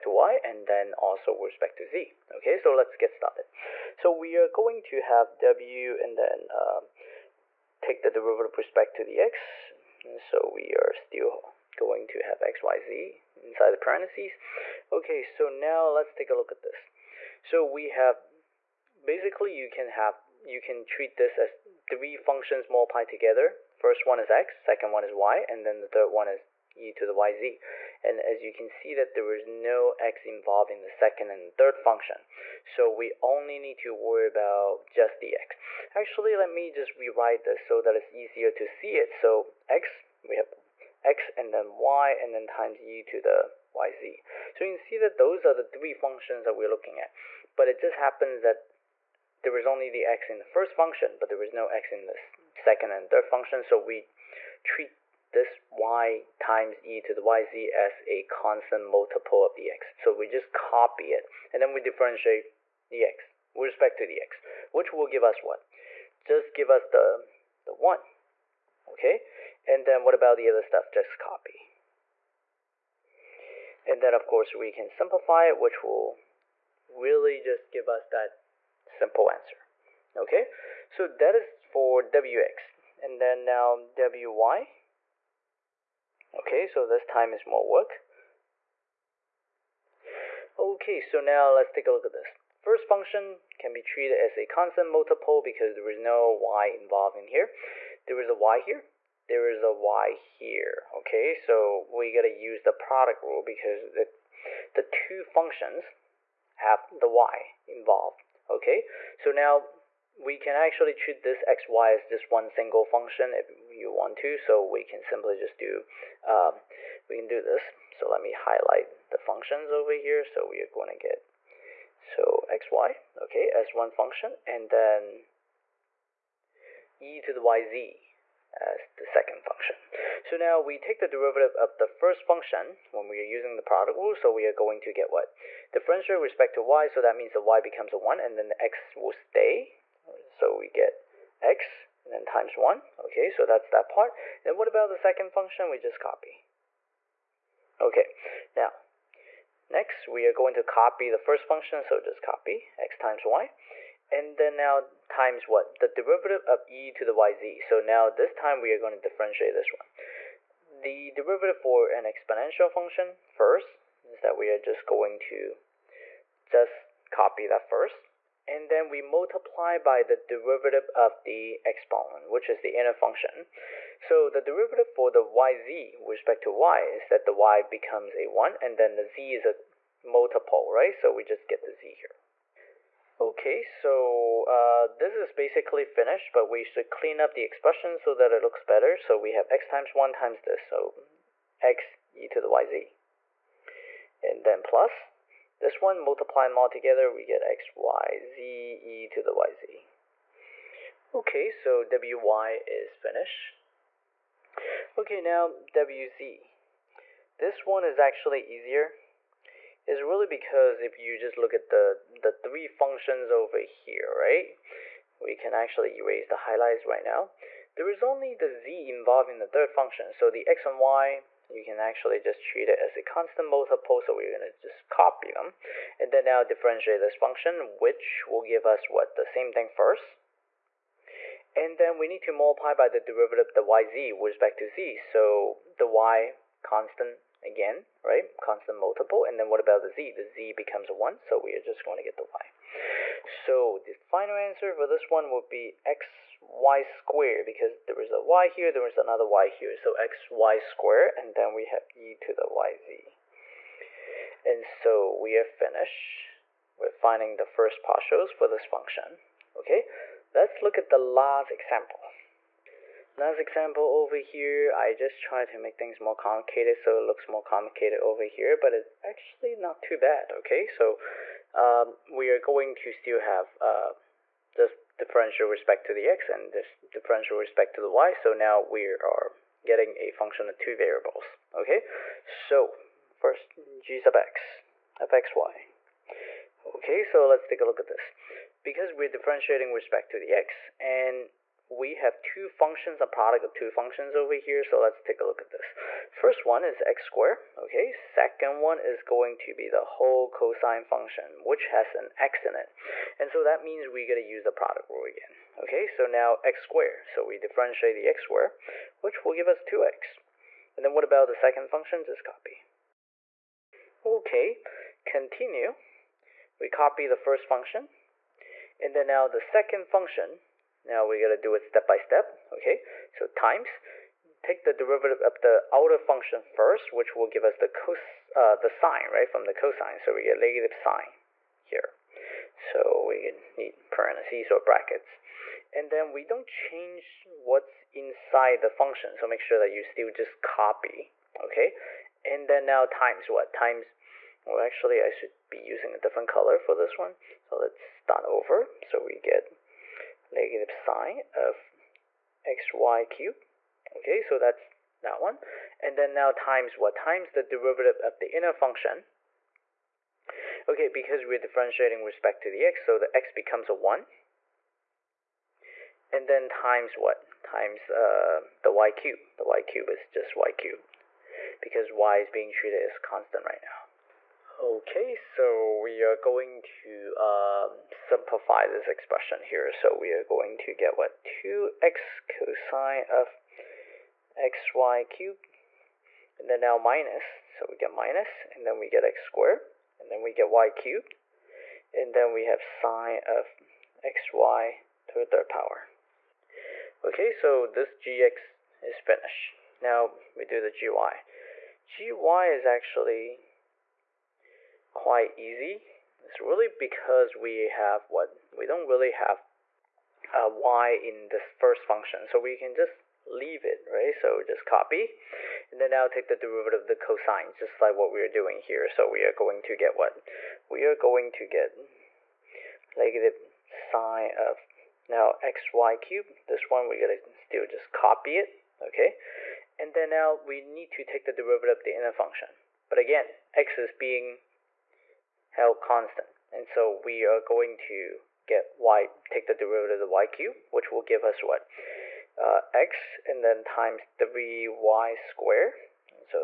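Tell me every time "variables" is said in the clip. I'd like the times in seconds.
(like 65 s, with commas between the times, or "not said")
280 s.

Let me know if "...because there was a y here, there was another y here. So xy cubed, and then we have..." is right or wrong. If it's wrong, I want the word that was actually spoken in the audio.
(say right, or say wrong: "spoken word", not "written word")
wrong: "squared", not "cubed".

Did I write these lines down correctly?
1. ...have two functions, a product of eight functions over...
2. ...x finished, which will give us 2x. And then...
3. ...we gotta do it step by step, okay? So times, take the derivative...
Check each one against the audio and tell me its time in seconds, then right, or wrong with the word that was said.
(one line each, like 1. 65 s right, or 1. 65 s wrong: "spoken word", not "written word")
1. 291 s wrong: "two", not "eight"
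2. 308 s wrong: "squared", not "finished"
3. 321 s right.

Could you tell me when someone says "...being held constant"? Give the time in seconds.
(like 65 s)
433 s.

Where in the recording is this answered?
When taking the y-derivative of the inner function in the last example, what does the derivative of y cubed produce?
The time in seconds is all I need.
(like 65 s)
444 s.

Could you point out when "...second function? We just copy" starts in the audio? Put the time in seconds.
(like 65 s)
144 s.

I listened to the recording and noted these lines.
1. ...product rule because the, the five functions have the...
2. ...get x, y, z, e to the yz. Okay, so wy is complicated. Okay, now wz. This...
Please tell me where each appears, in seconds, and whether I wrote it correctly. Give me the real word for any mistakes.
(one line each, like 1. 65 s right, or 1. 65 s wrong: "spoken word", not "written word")
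1. 102 s wrong: "two", not "five"
2. 197 s wrong: "finished", not "complicated".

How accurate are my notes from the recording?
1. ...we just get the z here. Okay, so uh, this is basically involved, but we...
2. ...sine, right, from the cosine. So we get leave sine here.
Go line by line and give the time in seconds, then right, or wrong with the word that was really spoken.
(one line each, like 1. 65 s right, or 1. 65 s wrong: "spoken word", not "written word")
1. 181 s wrong: "finished", not "involved"
2. 328 s wrong: "negative", not "leave".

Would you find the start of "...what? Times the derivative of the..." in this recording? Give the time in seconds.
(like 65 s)
356 s.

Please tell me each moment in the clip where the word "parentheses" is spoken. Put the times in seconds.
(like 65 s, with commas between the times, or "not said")
13 s, 333 s.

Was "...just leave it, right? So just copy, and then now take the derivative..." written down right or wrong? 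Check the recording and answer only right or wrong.
right.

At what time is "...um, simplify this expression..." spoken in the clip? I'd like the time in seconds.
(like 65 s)
377 s.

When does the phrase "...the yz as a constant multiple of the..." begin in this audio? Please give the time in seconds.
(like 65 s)
57 s.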